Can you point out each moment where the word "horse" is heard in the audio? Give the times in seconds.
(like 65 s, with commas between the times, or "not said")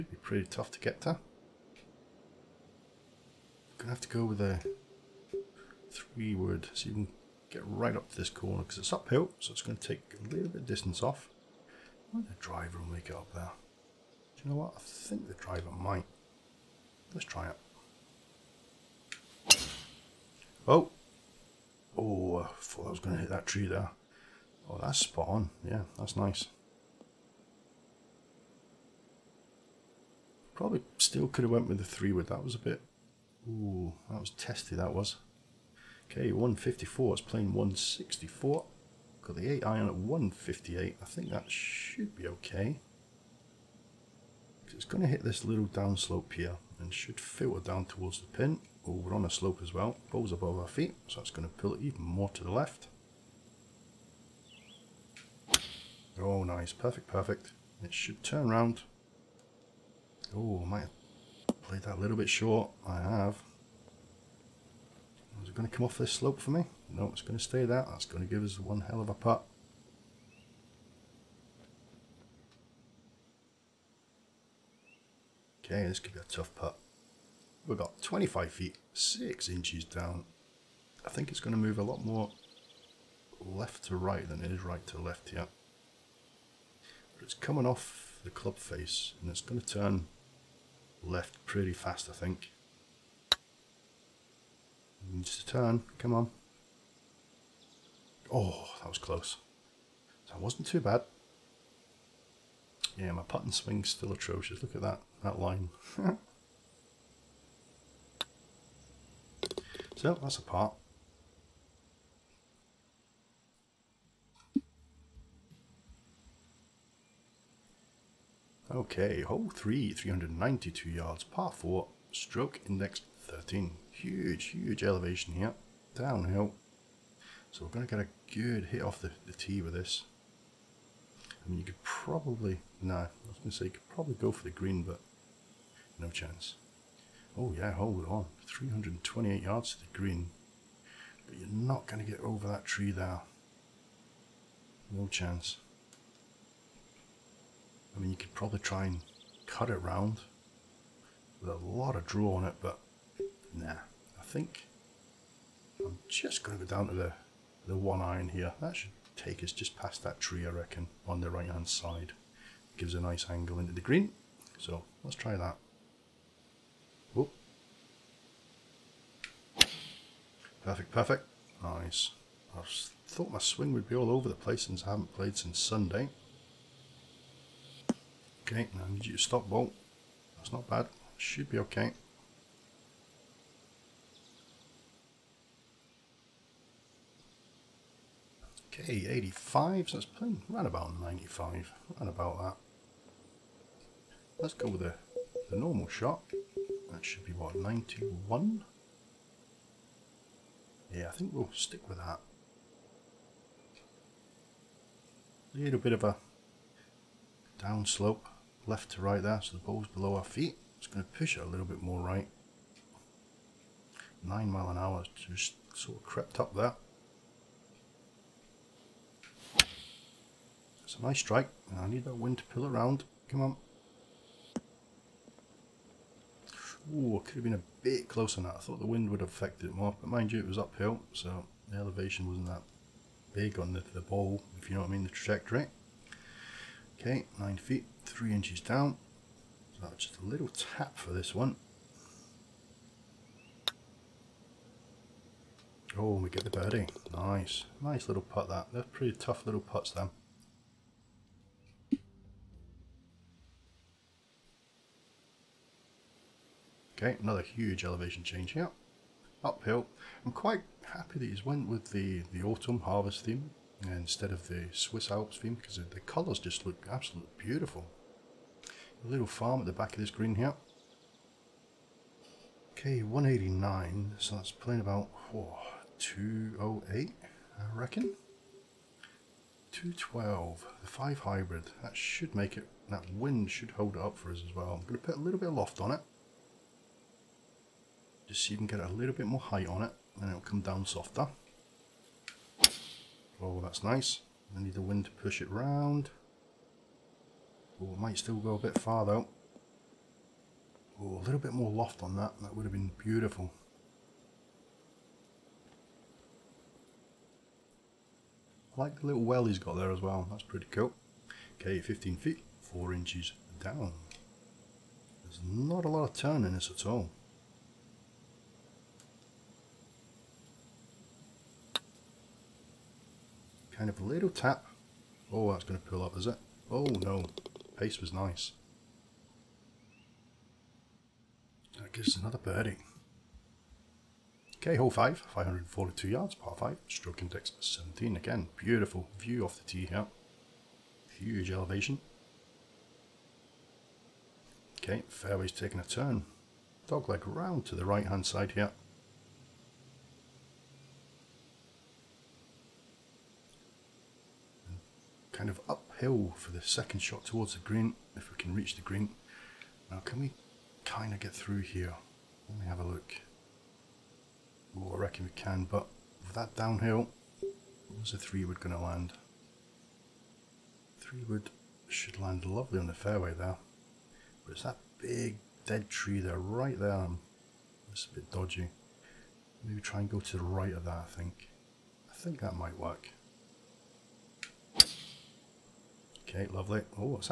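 not said.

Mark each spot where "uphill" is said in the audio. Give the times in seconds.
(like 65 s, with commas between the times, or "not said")
8 s, 230 s, 259 s, 355 s.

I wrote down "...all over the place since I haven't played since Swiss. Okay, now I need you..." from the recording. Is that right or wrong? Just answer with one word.
wrong.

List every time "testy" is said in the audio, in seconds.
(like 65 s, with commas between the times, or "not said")
34 s.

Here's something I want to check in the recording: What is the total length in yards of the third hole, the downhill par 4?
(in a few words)
392 yards.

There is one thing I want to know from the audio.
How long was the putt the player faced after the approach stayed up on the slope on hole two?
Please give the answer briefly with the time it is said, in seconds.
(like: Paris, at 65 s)
25 feet 6 inches, at 78 s.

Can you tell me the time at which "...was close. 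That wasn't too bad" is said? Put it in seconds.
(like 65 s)
98 s.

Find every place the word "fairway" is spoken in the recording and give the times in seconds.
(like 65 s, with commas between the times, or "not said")
345 s, 372 s.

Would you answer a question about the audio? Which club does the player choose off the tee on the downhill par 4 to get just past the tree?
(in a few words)
one iron.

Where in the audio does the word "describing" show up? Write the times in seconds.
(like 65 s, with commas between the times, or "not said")
not said.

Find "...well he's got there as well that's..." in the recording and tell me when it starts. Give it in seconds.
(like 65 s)
309 s.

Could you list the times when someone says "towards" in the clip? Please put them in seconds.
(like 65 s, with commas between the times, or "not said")
47 s, 357 s.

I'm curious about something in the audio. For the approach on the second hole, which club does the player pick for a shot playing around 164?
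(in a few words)
8 iron.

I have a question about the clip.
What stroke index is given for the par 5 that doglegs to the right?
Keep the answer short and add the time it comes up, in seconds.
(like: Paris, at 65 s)
17, at 337 s.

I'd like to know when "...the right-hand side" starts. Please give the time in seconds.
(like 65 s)
161 s.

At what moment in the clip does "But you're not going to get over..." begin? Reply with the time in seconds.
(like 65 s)
141 s.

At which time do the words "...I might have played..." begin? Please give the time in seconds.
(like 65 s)
60 s.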